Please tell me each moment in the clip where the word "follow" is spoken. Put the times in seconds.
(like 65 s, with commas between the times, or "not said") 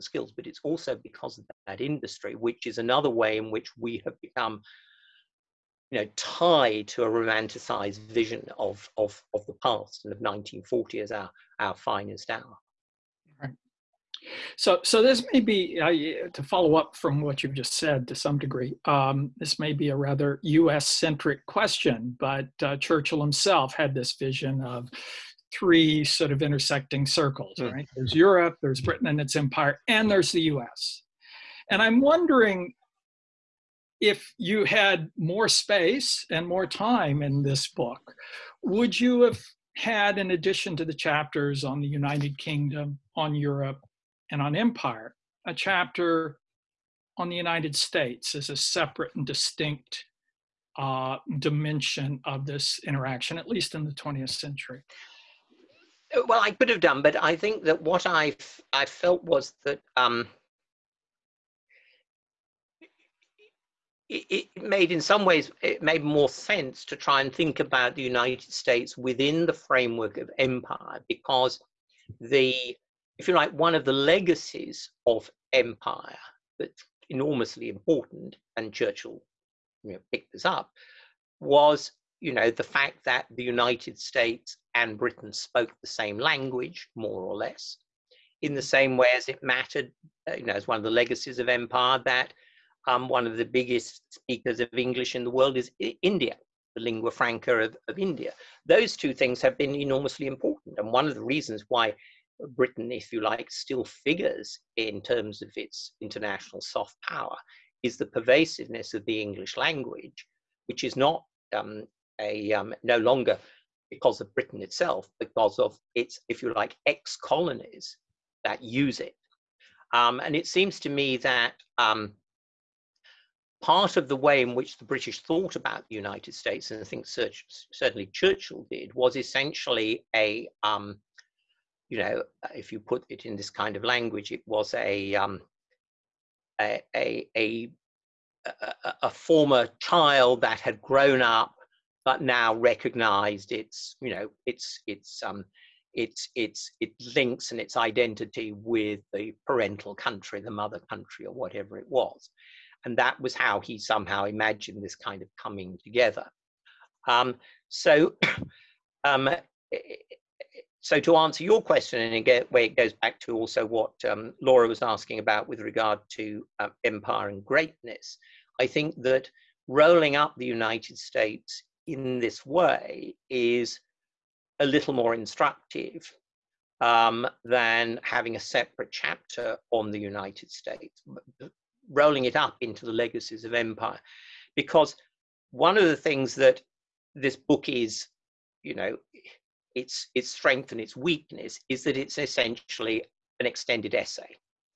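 16 s.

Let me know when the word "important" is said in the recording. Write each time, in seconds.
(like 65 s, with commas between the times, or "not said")
77 s, 100 s.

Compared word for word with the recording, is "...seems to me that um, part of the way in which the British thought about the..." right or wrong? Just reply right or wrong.
right.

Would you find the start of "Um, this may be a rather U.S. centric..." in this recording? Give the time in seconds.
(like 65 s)
18 s.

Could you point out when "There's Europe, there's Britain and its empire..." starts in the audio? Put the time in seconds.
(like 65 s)
27 s.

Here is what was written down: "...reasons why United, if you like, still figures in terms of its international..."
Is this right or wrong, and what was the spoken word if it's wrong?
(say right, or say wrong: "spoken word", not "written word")
wrong: "Britain", not "United".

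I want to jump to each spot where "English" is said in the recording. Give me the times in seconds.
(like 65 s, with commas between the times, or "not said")
94 s, 109 s.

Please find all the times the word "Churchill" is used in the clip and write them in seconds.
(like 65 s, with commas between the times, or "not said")
22 s, 78 s, 128 s.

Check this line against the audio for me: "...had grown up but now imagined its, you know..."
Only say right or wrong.
wrong.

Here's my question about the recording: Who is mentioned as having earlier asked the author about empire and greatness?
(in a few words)
Laura.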